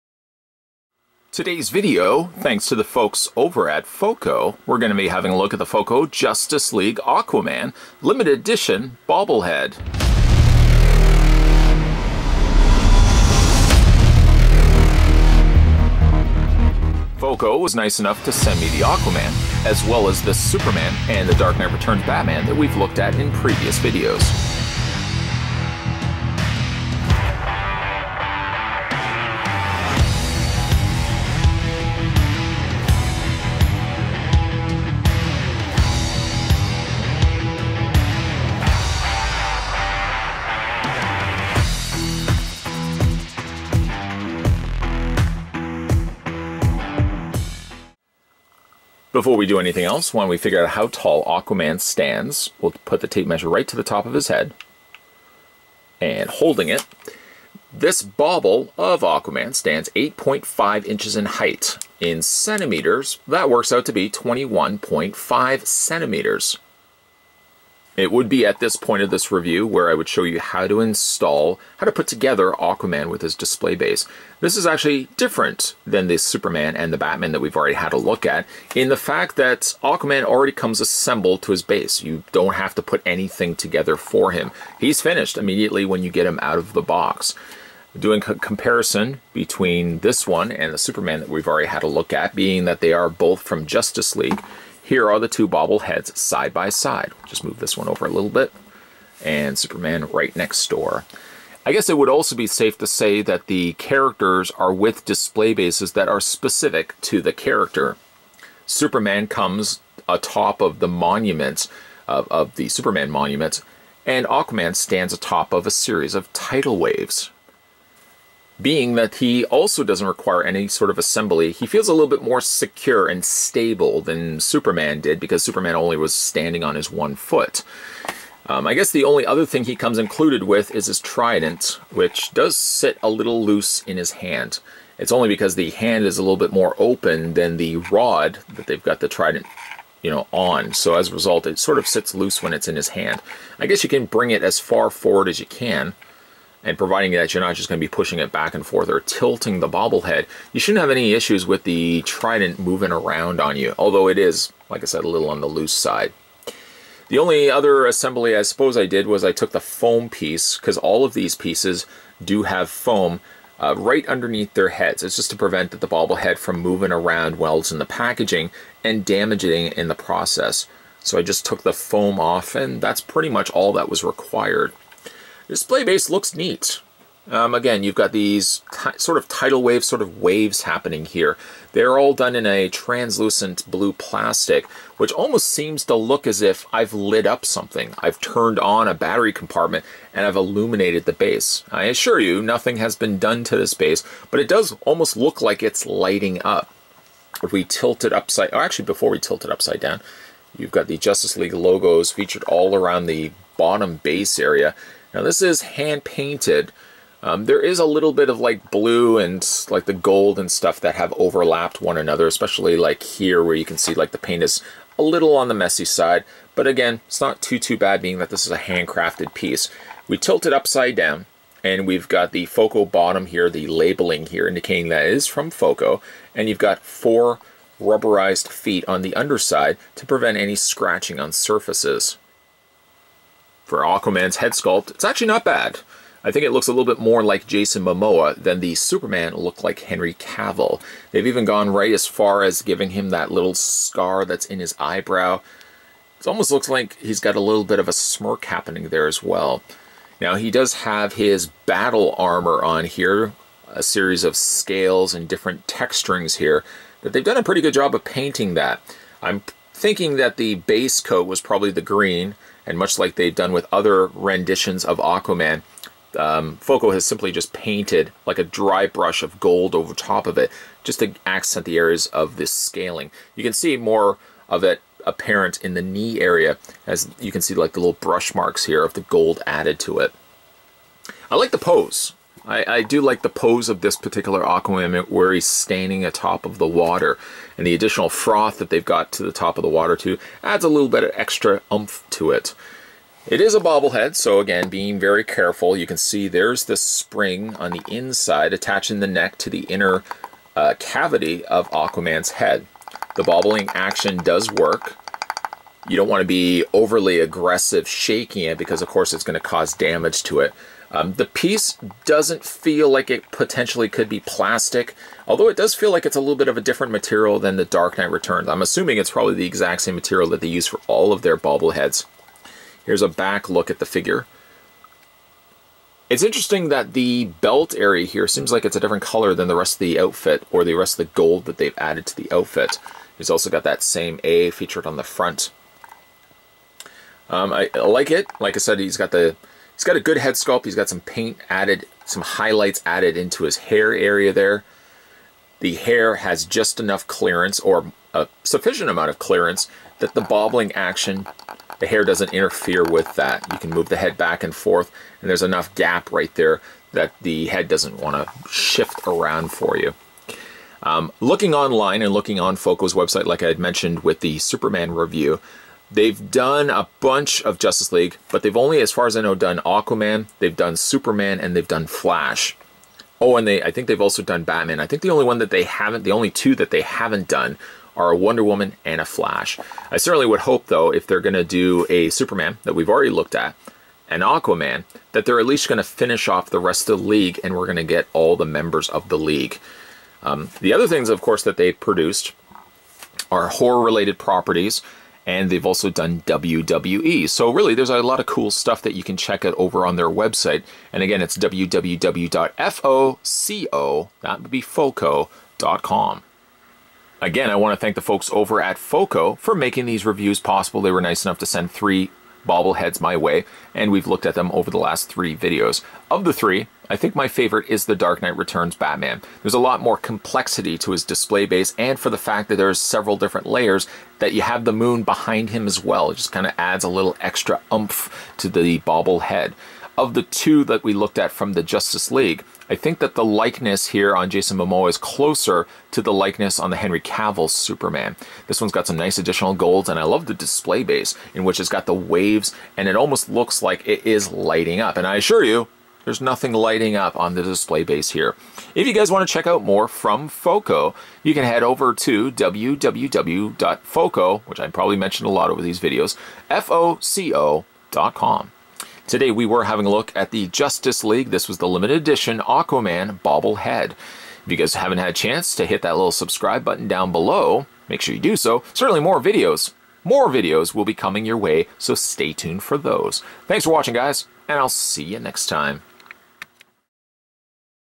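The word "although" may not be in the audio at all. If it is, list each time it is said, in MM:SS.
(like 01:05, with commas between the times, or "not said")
02:33, 05:15.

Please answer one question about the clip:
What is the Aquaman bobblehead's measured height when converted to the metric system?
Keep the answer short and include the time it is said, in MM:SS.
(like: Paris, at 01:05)
21.5 centimeters, at 01:04.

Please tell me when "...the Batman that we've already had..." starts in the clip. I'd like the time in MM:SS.
01:16.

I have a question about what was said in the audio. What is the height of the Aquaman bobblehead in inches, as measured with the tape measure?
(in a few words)
8.5 inches.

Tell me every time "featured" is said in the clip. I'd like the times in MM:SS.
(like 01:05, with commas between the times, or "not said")
03:22, 05:34.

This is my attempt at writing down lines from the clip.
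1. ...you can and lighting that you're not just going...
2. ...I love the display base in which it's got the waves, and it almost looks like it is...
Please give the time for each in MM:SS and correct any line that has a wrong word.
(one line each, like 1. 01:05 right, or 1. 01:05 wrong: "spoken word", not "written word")
1. 02:25 wrong: "providing", not "lighting"
2. 07:19 right.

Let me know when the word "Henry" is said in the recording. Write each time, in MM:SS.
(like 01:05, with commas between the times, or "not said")
03:59, 07:16.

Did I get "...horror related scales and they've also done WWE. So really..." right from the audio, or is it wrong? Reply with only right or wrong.
wrong.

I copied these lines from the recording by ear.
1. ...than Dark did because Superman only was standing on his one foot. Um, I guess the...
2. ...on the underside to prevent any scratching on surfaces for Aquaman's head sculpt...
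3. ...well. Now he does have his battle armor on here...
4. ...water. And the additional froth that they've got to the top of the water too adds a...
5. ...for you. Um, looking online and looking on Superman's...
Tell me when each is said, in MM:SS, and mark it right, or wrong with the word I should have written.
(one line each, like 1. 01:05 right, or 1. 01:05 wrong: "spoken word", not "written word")
1. 02:04 wrong: "Superman", not "Dark"
2. 03:48 right
3. 04:09 right
4. 04:46 right
5. 05:59 wrong: "Foco", not "Superman".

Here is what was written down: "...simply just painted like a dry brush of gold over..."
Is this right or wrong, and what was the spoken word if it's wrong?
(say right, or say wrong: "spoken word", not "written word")
right.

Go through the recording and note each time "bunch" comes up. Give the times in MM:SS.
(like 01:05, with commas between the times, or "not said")
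06:07.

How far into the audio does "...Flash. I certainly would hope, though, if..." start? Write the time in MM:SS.
06:19.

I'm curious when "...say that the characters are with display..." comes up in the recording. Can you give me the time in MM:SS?
01:42.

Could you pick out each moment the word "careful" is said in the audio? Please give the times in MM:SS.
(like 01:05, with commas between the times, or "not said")
04:55.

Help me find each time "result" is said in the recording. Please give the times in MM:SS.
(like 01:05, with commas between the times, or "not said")
02:21.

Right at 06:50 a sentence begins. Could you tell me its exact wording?
They were nice enough to send three bobbleheads my way, and we've looked at them over the last three videos.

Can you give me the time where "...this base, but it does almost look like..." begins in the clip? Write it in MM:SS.
03:13.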